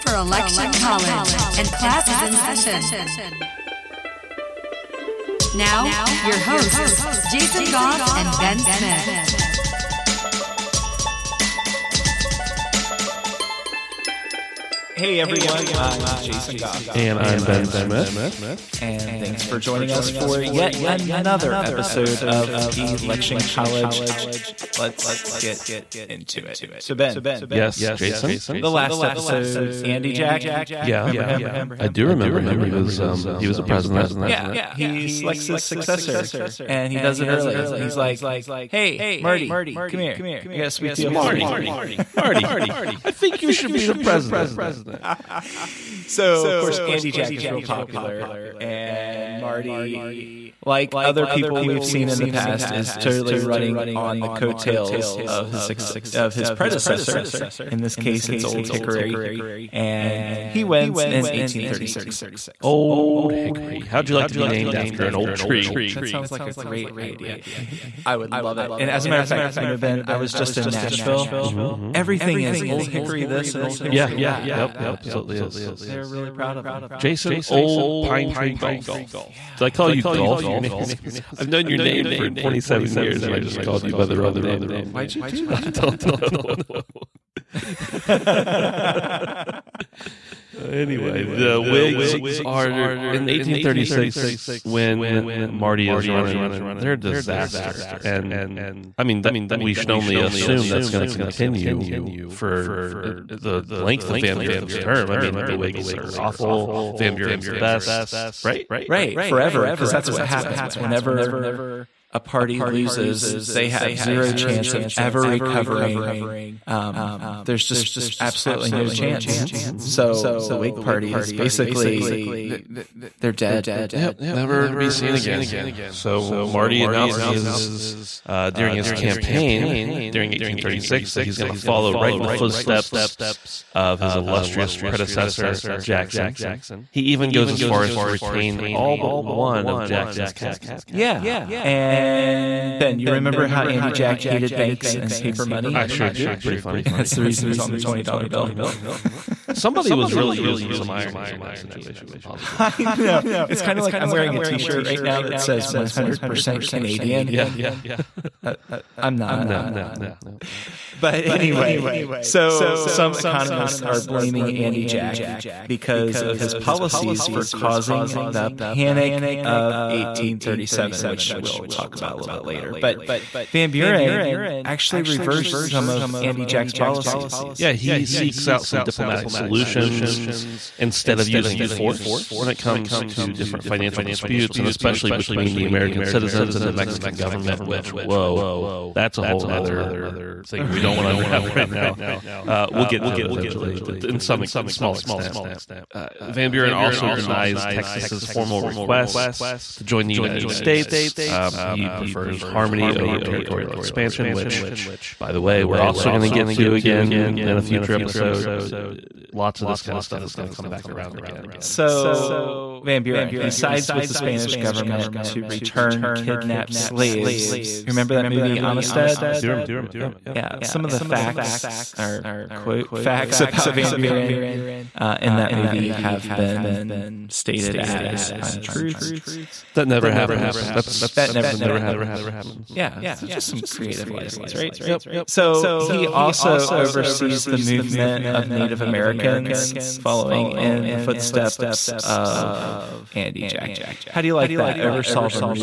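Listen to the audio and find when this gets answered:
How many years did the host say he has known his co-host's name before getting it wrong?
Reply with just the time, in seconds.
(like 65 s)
82 s.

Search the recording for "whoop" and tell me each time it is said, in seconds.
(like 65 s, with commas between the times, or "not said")
not said.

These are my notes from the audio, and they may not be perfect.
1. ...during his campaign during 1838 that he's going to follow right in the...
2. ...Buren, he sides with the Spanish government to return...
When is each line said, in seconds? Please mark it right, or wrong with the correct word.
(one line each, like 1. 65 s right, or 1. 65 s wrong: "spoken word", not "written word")
1. 128 s wrong: "1836", not "1838"
2. 213 s right.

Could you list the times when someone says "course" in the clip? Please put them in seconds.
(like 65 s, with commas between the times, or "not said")
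46 s.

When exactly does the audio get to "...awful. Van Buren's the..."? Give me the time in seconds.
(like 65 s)
106 s.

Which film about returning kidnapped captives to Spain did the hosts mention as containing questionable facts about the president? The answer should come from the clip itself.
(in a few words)
Amistad.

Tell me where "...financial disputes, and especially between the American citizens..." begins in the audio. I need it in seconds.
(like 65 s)
183 s.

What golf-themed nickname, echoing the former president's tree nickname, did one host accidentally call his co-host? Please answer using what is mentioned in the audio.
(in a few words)
Jason Old Pine Tree Golf.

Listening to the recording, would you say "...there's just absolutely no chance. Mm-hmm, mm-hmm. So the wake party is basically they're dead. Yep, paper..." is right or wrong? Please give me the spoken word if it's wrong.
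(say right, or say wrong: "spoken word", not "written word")
wrong: "never", not "paper".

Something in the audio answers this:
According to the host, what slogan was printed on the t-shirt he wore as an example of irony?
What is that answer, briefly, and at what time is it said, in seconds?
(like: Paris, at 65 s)
100% Canadian, at 155 s.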